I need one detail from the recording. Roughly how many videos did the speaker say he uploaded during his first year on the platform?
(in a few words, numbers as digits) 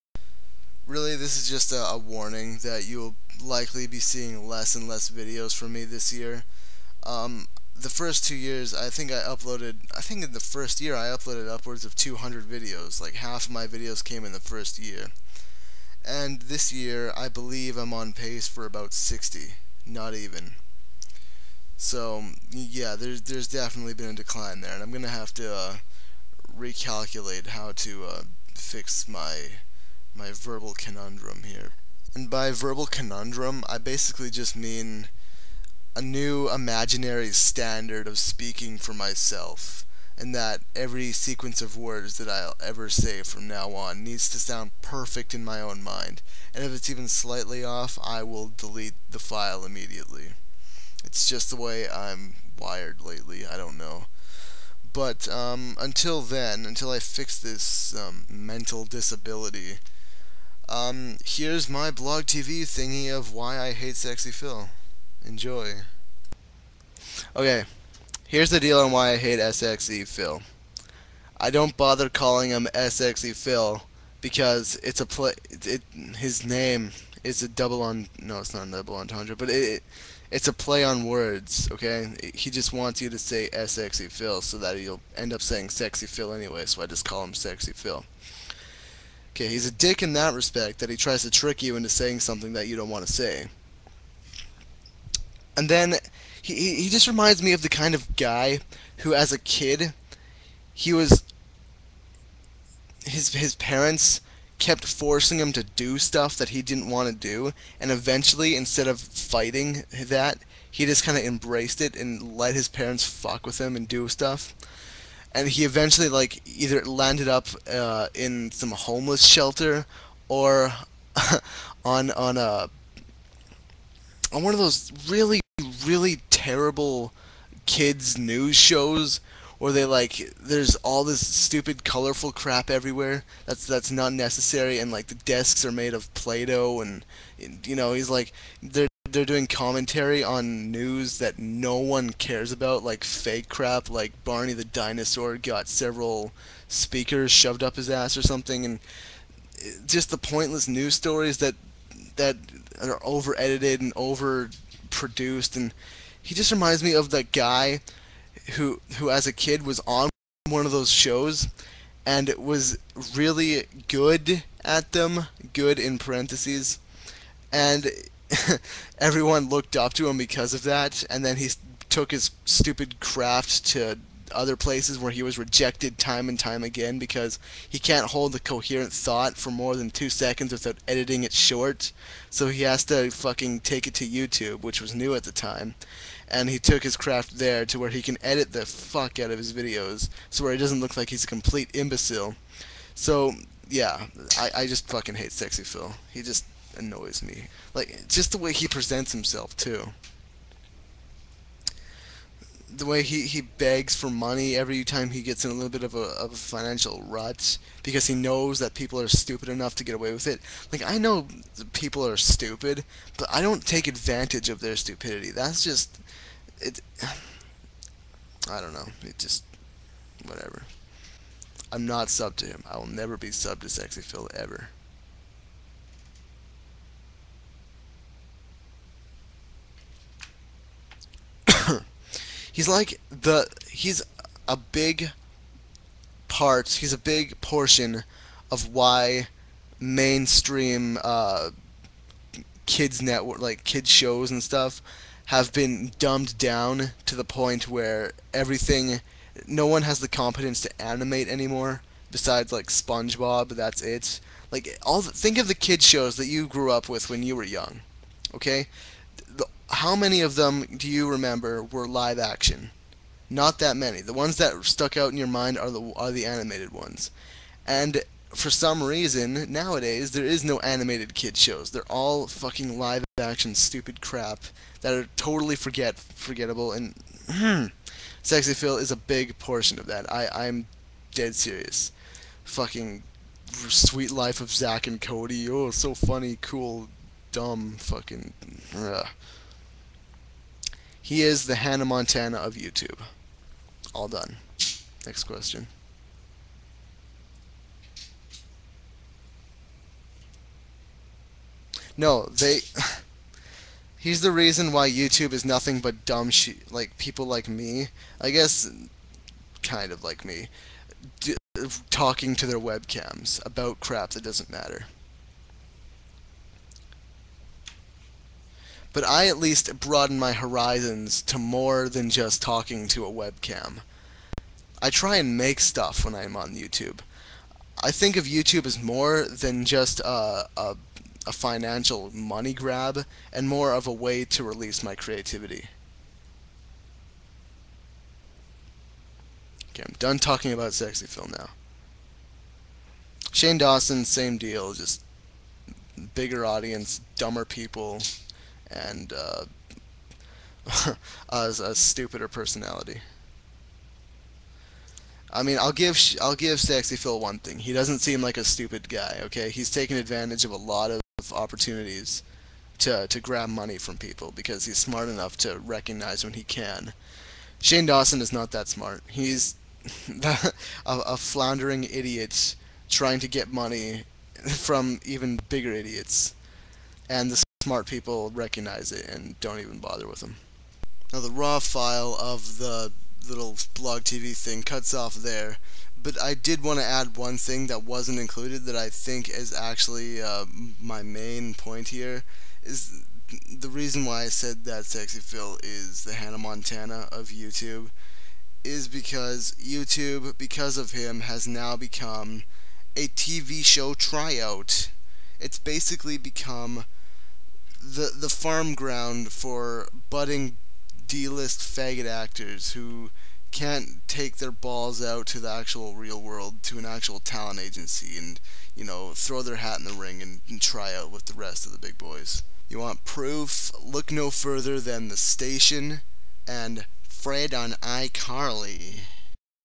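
200.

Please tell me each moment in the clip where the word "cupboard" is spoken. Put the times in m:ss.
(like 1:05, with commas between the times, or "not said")
not said.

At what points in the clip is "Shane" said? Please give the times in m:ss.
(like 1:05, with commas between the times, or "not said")
5:43, 6:07.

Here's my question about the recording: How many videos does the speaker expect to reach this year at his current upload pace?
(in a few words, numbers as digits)
60.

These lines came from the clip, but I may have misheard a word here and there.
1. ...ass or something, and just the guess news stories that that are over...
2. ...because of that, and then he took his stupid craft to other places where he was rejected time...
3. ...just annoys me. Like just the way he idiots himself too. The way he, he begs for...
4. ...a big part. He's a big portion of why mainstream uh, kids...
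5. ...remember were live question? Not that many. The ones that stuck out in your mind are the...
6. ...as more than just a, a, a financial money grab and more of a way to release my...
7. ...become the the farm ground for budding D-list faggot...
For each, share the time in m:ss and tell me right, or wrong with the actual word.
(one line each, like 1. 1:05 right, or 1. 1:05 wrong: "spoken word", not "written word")
1. 2:27 wrong: "pointless", not "guess"
2. 2:50 right
3. 3:16 wrong: "presents", not "idiots"
4. 3:54 right
5. 4:21 wrong: "action", not "question"
6. 5:28 right
7. 6:46 right.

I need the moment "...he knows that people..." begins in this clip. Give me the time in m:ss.
3:28.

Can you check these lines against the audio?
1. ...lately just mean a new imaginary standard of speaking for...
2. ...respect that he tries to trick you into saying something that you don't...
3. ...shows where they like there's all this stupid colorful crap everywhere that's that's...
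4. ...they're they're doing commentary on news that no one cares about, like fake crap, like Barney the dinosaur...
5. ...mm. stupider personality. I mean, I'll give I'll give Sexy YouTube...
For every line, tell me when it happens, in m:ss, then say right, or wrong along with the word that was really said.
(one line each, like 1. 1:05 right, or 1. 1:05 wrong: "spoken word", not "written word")
1. 0:33 wrong: "basically", not "lately"
2. 1:30 right
3. 2:08 right
4. 2:18 right
5. 5:51 wrong: "Phil", not "YouTube".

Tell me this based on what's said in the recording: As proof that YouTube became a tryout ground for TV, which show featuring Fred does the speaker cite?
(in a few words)
iCarly.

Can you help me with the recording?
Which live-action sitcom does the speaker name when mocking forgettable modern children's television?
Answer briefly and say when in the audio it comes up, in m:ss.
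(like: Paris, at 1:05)
Suite Life of Zack and Cody, at 4:43.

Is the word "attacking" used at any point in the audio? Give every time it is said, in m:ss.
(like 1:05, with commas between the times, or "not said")
not said.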